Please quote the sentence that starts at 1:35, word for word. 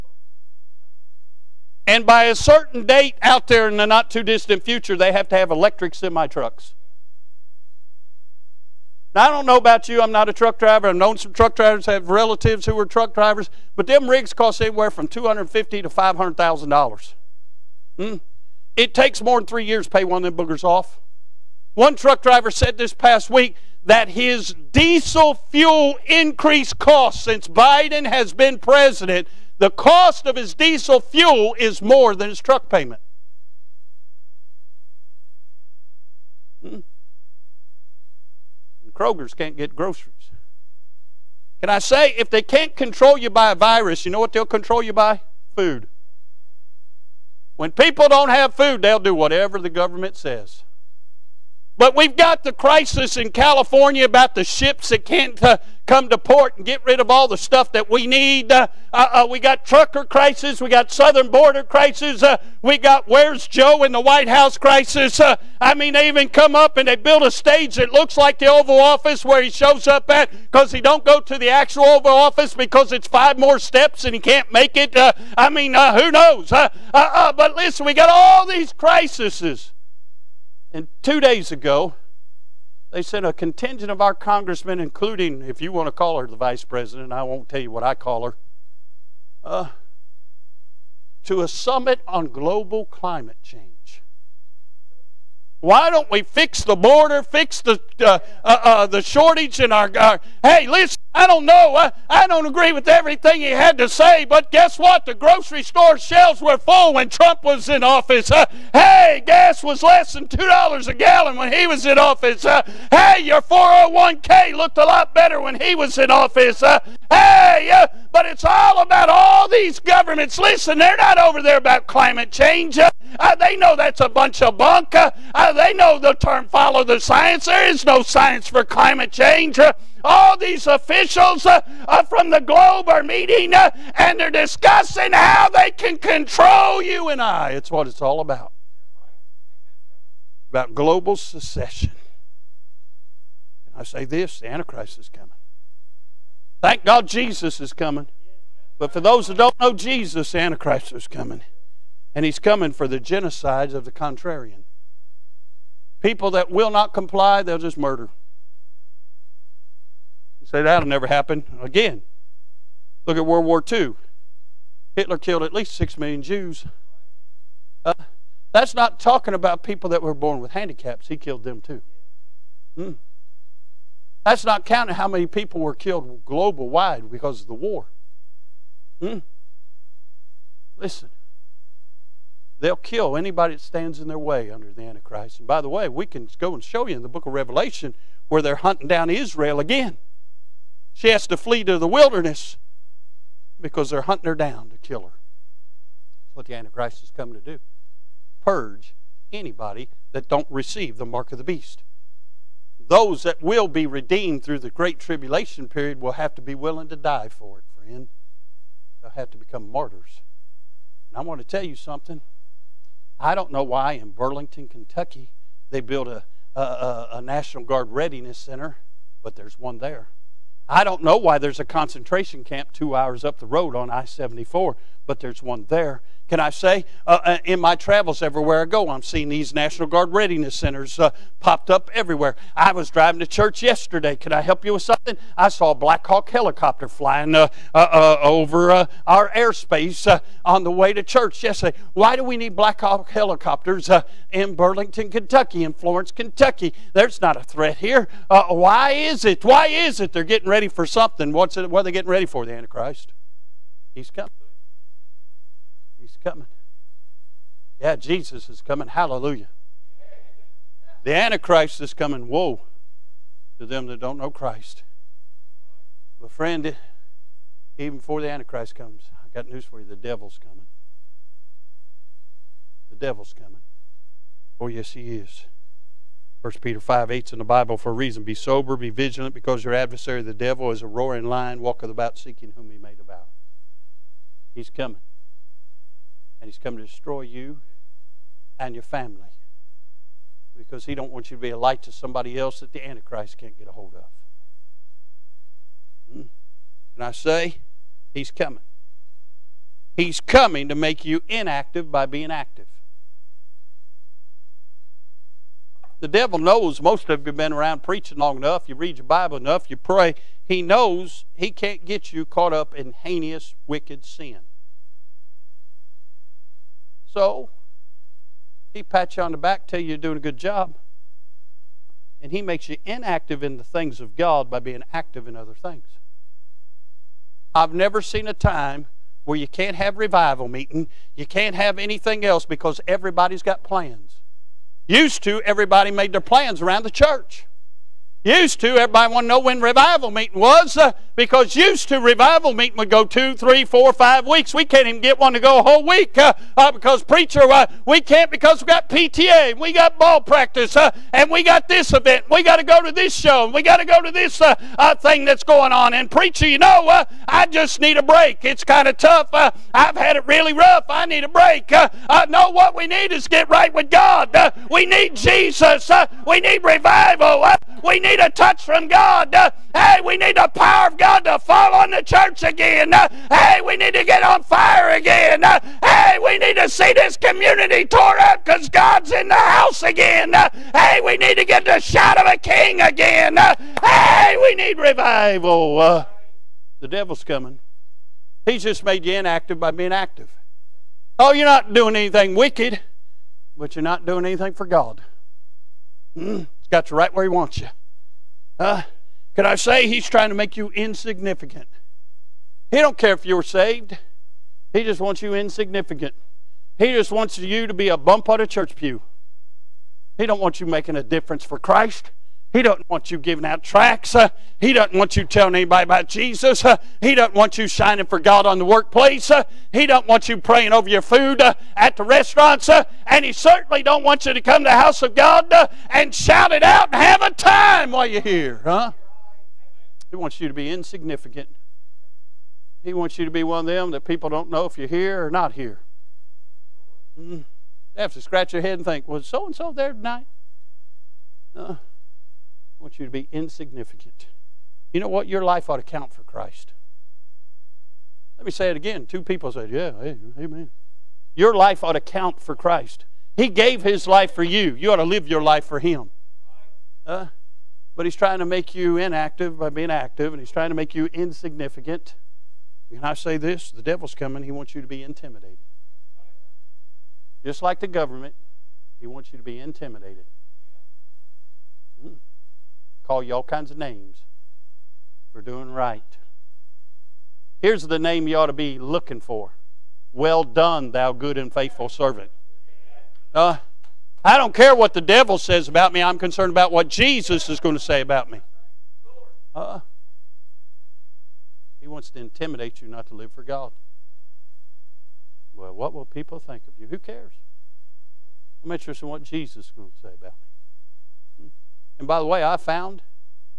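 Why don't we fix the border, fix the, uh, uh, uh the shortage in our.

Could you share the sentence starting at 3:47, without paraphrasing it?
Uh, uh, in my travels everywhere I go, I'm seeing these National Guard readiness centers uh, popped up everywhere.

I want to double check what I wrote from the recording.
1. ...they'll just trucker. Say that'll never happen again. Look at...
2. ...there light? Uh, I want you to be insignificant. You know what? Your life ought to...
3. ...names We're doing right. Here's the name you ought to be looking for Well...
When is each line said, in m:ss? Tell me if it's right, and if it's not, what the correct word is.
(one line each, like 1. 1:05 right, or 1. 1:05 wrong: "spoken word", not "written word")
1. 2:37 wrong: "murder", not "trucker"
2. 7:19 wrong: "tonight", not "light"
3. 7:53 right.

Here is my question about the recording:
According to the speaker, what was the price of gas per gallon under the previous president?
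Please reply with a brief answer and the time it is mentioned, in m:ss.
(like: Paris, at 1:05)
less than $2, at 1:49.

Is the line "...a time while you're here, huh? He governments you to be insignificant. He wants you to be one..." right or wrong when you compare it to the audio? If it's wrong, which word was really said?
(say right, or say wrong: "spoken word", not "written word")
wrong: "wants", not "governments".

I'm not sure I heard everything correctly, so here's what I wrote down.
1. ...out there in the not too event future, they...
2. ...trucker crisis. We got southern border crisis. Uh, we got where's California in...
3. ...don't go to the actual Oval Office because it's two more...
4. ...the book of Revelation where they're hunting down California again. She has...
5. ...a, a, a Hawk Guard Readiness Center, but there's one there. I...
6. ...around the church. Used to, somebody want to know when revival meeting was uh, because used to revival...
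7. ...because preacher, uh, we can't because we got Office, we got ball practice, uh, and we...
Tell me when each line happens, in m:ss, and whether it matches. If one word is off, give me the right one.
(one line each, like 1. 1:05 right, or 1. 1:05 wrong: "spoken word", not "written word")
1. 0:03 wrong: "distant", not "event"
2. 0:59 wrong: "Joe", not "California"
3. 1:10 wrong: "five", not "two"
4. 3:07 wrong: "Israel", not "California"
5. 3:36 wrong: "National", not "Hawk"
6. 5:36 wrong: "everybody", not "somebody"
7. 5:46 wrong: "PTA", not "Office".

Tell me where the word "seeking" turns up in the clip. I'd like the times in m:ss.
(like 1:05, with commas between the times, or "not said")
4:42.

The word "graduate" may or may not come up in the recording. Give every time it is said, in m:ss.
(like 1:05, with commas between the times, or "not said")
not said.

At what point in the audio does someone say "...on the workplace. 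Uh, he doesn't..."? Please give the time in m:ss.
6:58.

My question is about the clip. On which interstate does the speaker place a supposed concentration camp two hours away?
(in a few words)
I 74.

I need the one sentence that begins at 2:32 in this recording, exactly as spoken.
And he's coming for the genocides of the contrarian.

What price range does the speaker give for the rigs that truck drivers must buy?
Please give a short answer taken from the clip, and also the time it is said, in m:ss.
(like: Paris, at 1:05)
$250,000 to $500,000, at 0:15.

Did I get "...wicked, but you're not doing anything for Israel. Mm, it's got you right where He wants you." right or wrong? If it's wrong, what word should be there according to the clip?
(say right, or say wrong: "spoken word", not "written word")
wrong: "God", not "Israel".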